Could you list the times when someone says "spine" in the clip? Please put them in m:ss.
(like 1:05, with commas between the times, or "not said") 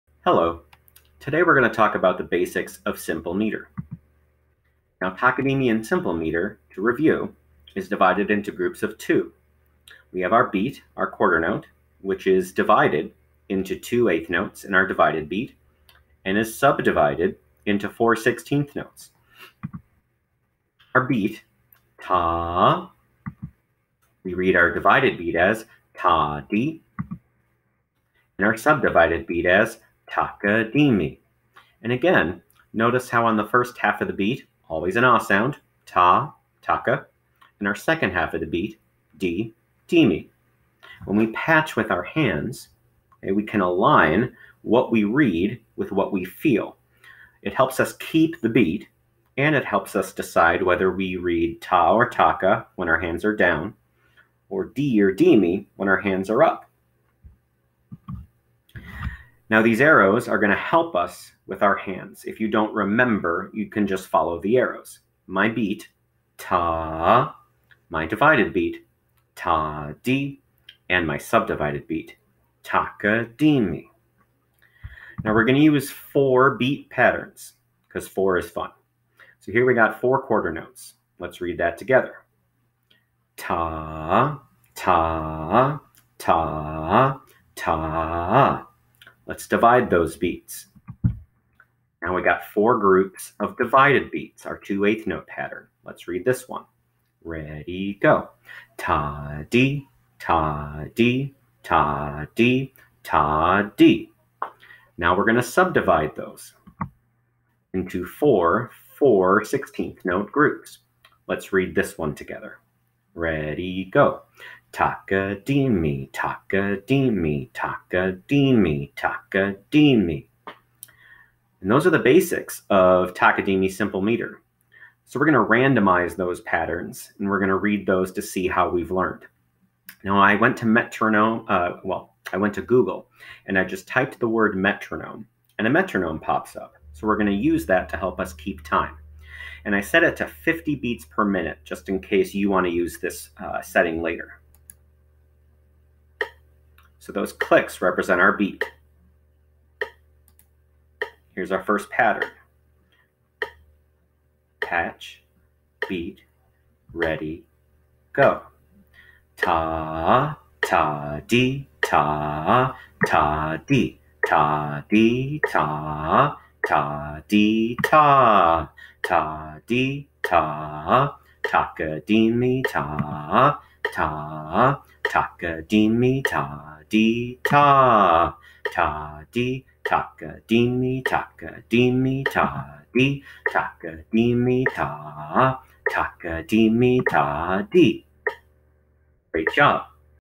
not said.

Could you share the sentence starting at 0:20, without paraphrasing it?
Our beat, ta, we read our divided beat as ta di, and our subdivided beat as Takadimi.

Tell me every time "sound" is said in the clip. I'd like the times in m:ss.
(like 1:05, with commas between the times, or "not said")
0:35.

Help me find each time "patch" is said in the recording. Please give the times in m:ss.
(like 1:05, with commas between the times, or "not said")
0:41, 2:34.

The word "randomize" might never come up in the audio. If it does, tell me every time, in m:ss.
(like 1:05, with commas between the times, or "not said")
2:05.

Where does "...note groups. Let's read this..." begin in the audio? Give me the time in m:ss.
1:50.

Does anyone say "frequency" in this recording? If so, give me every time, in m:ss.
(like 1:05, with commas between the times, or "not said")
not said.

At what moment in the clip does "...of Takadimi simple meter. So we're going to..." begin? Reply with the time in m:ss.
2:02.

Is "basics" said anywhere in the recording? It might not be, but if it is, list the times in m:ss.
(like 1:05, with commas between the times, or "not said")
0:02, 2:01.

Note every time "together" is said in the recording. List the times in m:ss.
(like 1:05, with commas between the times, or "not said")
1:21, 1:52.